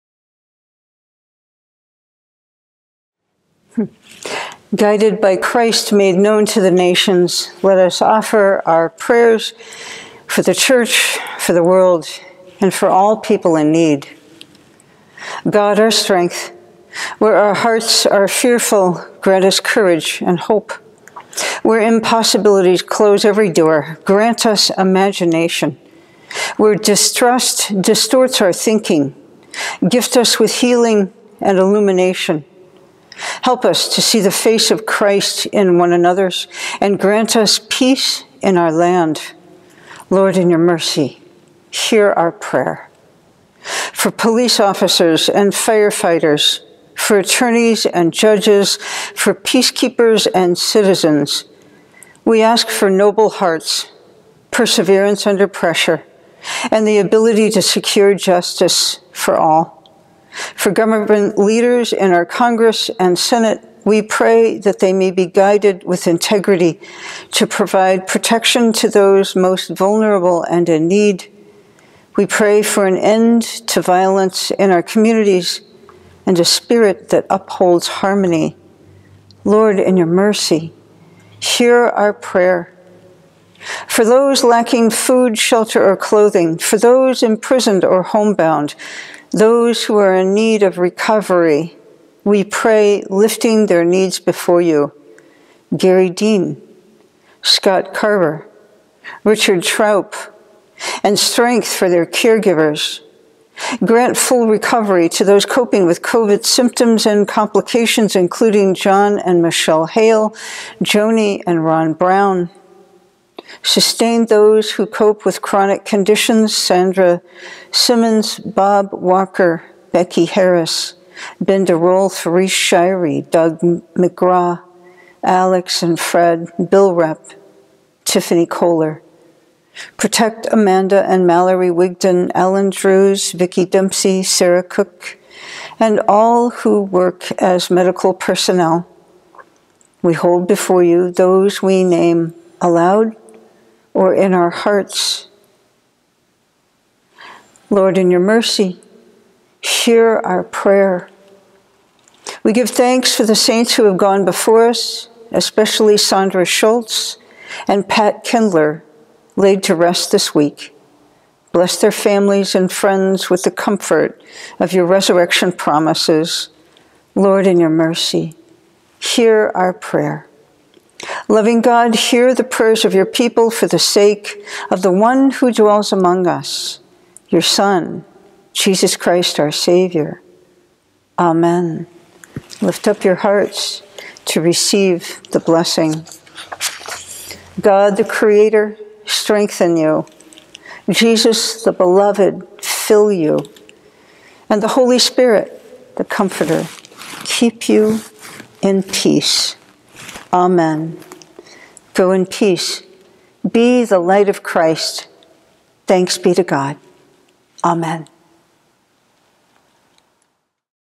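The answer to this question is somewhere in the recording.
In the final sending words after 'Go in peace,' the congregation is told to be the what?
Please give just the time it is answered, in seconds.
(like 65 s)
203 s.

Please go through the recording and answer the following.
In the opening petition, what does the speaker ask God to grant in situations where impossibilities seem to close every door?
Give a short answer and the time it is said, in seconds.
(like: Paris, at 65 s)
imagination, at 24 s.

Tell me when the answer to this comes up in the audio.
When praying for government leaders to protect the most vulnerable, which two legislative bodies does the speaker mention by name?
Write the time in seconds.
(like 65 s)
62 s.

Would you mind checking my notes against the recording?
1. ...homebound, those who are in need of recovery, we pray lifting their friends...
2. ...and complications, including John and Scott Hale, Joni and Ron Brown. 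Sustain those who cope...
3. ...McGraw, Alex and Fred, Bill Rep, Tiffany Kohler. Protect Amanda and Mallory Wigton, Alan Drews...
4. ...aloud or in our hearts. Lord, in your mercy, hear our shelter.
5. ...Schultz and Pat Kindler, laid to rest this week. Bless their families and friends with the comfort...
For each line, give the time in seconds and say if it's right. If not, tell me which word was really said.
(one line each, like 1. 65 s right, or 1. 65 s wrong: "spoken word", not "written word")
1. 88 s wrong: "needs", not "friends"
2. 107 s wrong: "Michelle", not "Scott"
3. 123 s right
4. 142 s wrong: "prayer", not "shelter"
5. 156 s right.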